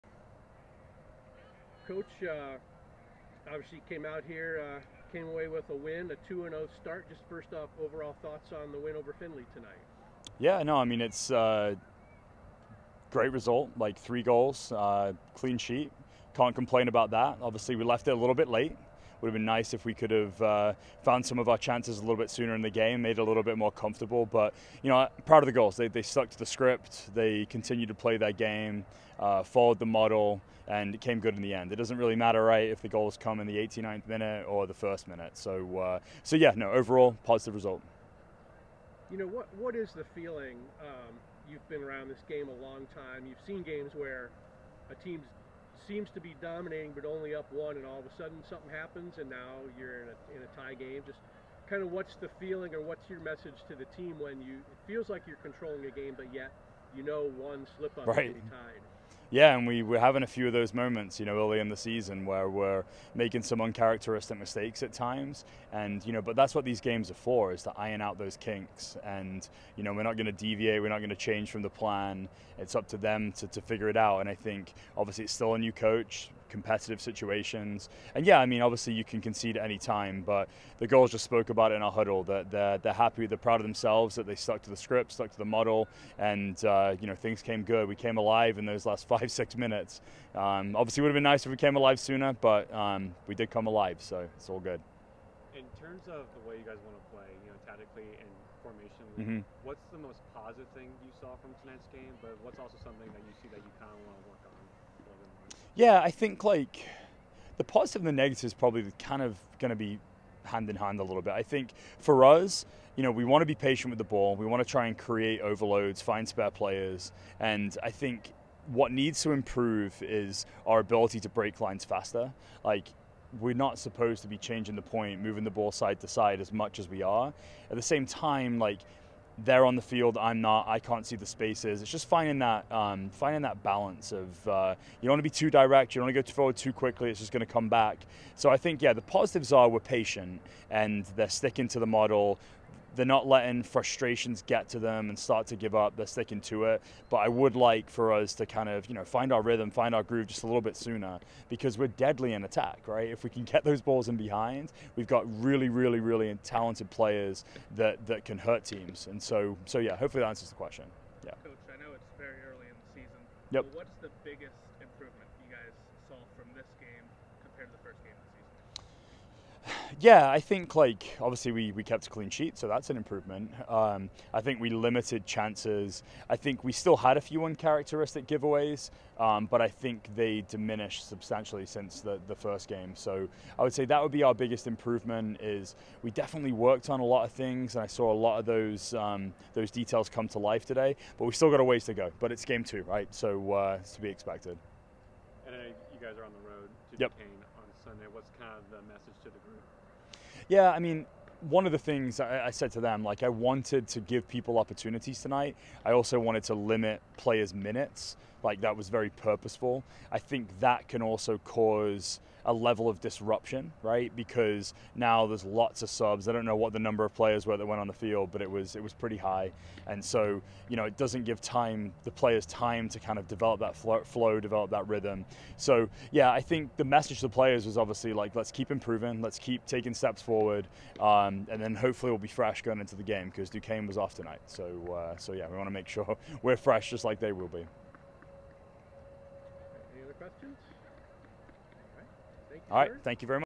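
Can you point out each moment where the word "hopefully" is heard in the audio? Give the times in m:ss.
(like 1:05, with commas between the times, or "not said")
2:39, 3:51.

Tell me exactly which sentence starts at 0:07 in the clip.
Just first off, overall thoughts on the win over Findlay tonight?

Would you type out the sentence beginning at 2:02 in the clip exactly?
Like we're not supposed to be changing the point, moving the ball side to side as much as we are.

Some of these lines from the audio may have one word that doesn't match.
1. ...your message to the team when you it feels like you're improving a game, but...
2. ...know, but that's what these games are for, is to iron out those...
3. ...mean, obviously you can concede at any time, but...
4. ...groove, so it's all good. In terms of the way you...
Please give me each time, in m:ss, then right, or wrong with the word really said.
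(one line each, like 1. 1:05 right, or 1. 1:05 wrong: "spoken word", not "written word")
1. 0:53 wrong: "controlling", not "improving"
2. 1:06 right
3. 1:18 right
4. 1:33 wrong: "alive", not "groove".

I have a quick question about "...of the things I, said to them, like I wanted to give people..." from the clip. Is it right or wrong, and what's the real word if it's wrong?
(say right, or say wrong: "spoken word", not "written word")
right.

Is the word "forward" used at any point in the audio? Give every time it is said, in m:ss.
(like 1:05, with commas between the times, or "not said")
2:16, 3:50.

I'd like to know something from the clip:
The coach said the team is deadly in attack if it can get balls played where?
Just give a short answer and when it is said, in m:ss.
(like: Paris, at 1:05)
In behind, at 2:34.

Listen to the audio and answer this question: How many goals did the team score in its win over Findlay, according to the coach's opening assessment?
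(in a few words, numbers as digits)
3.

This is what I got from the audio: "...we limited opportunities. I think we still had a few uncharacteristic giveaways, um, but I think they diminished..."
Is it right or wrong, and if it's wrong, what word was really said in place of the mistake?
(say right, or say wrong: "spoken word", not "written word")
wrong: "chances", not "opportunities".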